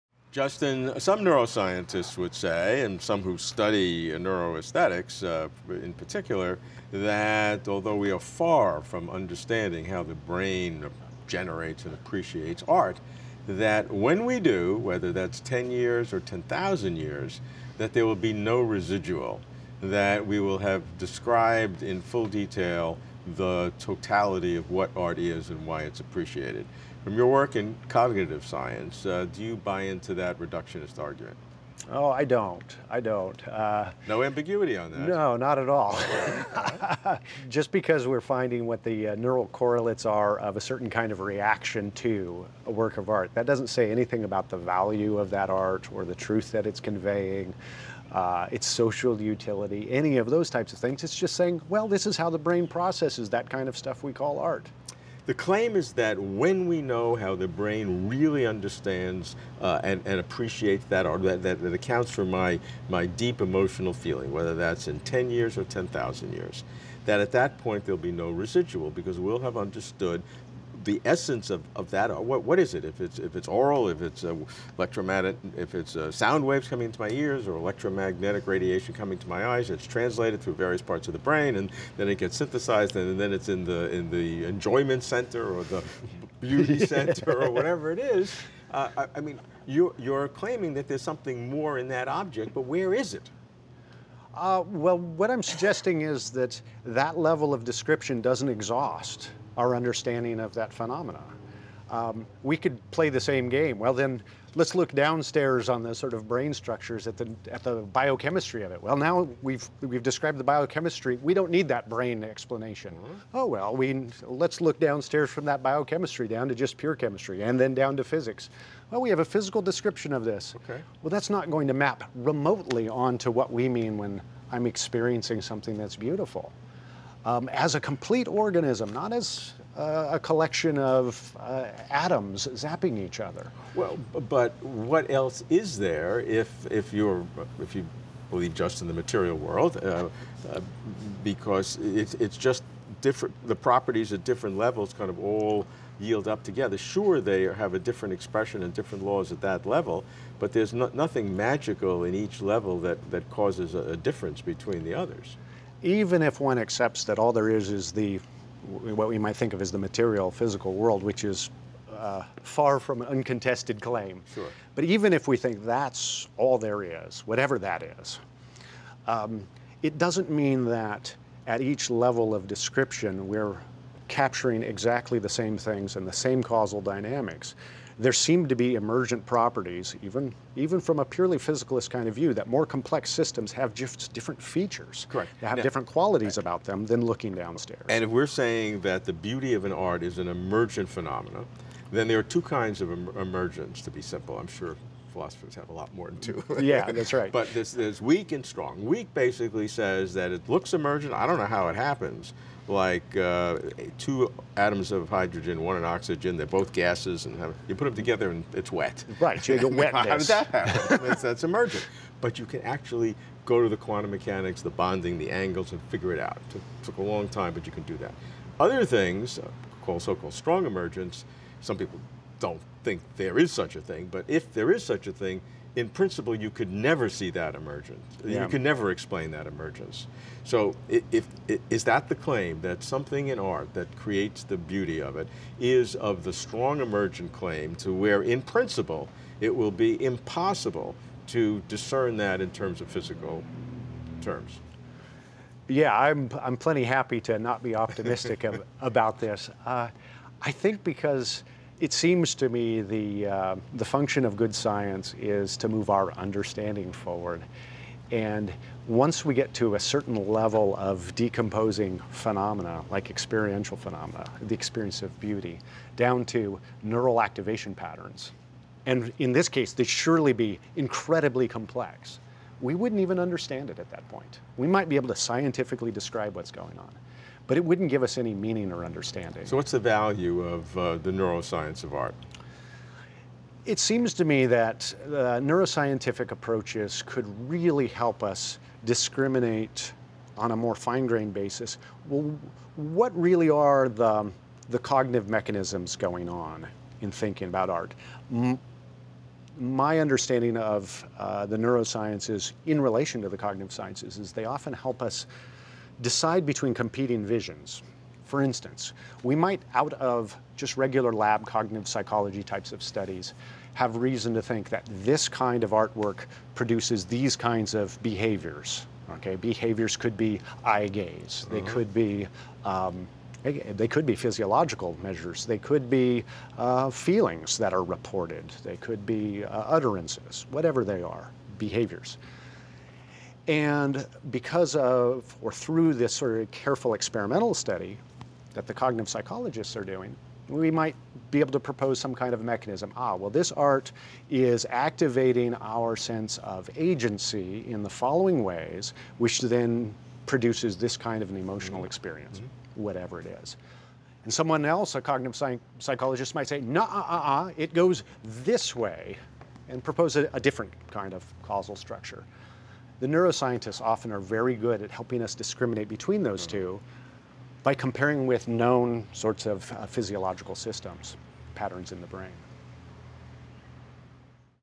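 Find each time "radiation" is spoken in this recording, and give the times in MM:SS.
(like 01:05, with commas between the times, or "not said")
01:18.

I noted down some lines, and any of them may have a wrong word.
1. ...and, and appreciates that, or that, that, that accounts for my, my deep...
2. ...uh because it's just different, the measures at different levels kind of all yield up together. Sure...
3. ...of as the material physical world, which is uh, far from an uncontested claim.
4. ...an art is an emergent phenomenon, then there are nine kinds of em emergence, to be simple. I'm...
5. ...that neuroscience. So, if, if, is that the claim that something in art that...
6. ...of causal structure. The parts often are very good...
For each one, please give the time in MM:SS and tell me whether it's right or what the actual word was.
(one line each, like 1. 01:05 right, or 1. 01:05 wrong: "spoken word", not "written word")
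1. 00:59 right
2. 02:20 wrong: "properties", not "measures"
3. 02:39 right
4. 03:09 wrong: "two", not "nine"
5. 03:49 wrong: "emergence", not "neuroscience"
6. 06:01 wrong: "neuroscientists", not "parts".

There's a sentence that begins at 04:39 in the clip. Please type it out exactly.
So what's the value of uh, the neuroscience of art?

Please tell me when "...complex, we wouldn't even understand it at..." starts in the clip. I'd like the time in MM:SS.
04:31.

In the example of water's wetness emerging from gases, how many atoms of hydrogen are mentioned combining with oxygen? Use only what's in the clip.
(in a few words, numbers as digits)
2.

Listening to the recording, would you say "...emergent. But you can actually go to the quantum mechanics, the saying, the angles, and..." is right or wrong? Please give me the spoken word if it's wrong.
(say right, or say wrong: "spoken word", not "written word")
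wrong: "bonding", not "saying".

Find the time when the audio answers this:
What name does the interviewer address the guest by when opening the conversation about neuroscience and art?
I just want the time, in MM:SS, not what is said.
00:00.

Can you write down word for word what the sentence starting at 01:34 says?
Uh, well, what I'm suggesting is that that level of description doesn't exhaust our understanding of that phenomena.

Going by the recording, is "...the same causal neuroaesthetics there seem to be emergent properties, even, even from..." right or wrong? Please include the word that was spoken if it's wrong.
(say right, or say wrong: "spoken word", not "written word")
wrong: "dynamics", not "neuroaesthetics".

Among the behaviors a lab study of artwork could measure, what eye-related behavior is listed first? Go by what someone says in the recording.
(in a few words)
eye gaze.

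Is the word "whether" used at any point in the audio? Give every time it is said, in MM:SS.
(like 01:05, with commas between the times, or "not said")
00:14, 01:04.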